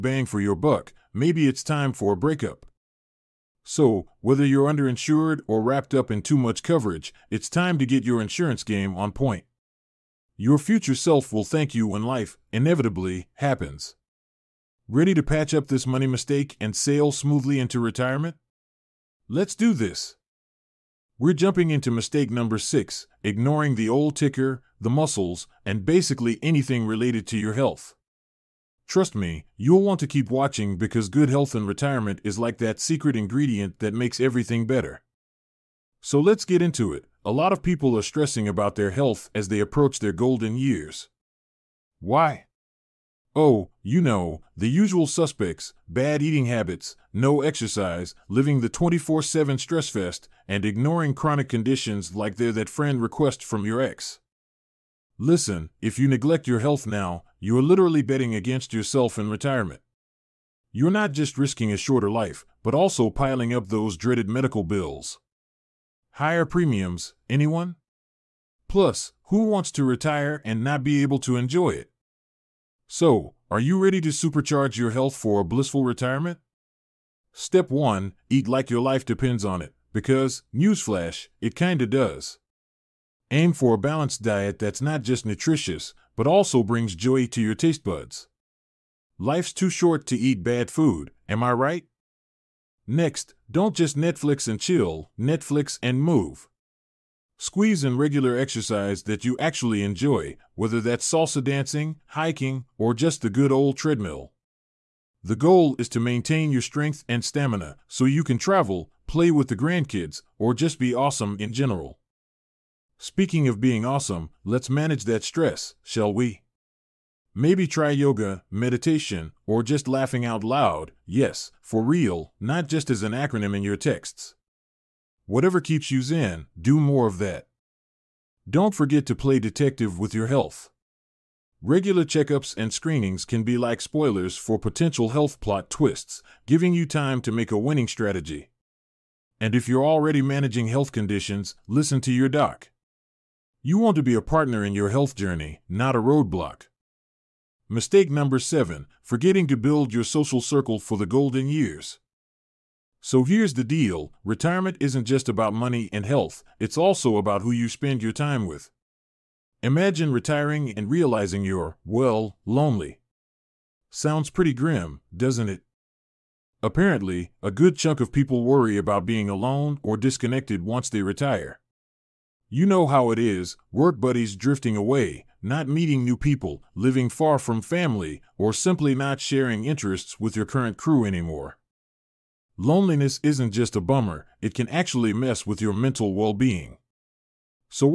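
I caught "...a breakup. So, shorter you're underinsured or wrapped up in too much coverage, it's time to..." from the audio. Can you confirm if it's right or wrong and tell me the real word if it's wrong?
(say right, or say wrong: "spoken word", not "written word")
wrong: "whether", not "shorter".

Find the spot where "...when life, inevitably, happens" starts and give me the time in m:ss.
0:11.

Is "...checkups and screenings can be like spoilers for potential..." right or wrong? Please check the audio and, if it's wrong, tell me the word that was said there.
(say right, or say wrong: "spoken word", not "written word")
right.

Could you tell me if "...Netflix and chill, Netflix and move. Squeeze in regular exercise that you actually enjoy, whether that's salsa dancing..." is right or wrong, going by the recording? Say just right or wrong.
right.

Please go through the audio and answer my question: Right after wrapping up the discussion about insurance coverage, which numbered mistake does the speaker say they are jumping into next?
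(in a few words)
6.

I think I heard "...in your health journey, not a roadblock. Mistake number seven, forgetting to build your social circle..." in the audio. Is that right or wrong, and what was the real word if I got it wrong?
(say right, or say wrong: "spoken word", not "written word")
right.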